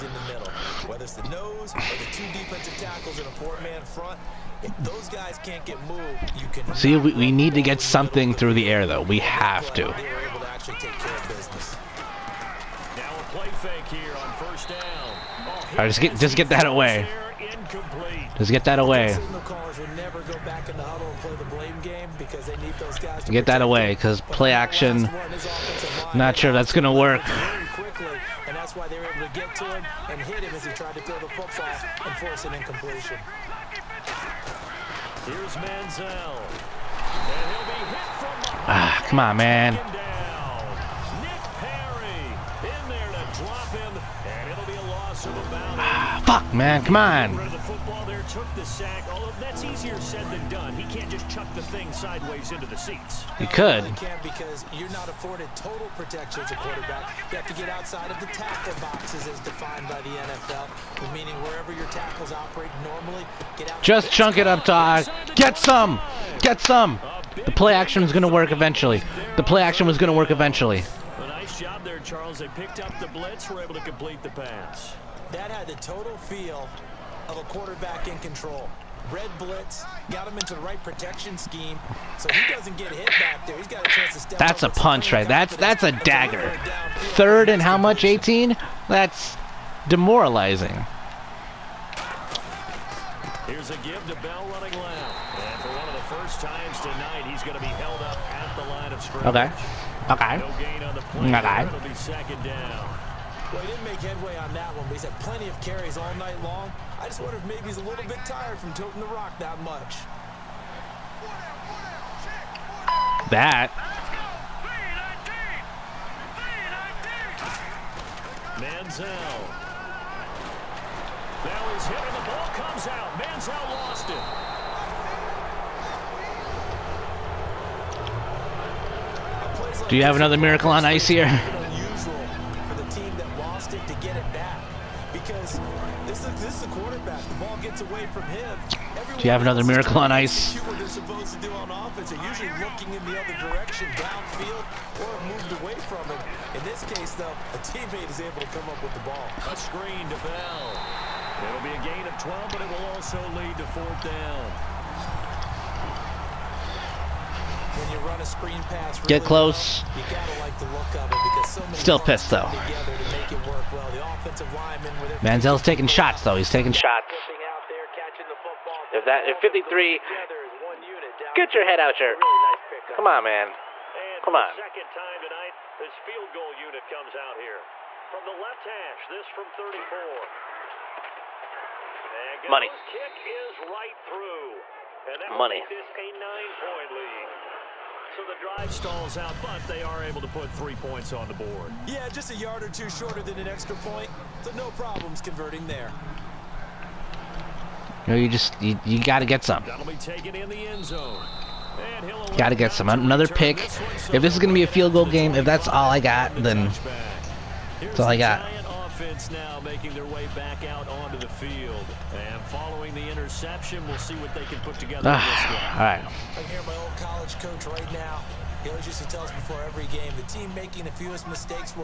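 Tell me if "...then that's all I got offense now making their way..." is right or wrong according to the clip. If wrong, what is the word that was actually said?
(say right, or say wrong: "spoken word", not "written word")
wrong: "defense", not "offense".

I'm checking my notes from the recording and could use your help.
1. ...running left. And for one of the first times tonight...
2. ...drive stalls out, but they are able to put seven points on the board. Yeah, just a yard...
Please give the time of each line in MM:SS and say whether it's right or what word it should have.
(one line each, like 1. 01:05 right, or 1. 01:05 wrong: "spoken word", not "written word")
1. 01:34 right
2. 03:08 wrong: "three", not "seven".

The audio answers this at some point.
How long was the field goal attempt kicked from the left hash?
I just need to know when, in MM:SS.
02:59.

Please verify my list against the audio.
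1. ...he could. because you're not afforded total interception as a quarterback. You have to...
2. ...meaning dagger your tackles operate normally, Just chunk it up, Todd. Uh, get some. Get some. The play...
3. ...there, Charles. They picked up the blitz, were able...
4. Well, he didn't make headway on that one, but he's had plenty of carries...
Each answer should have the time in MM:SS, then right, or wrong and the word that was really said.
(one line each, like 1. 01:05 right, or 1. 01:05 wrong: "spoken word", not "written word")
1. 00:53 wrong: "protection", not "interception"
2. 01:01 wrong: "wherever", not "dagger"
3. 01:11 right
4. 01:43 right.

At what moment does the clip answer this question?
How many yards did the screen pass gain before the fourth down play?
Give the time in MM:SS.
02:32.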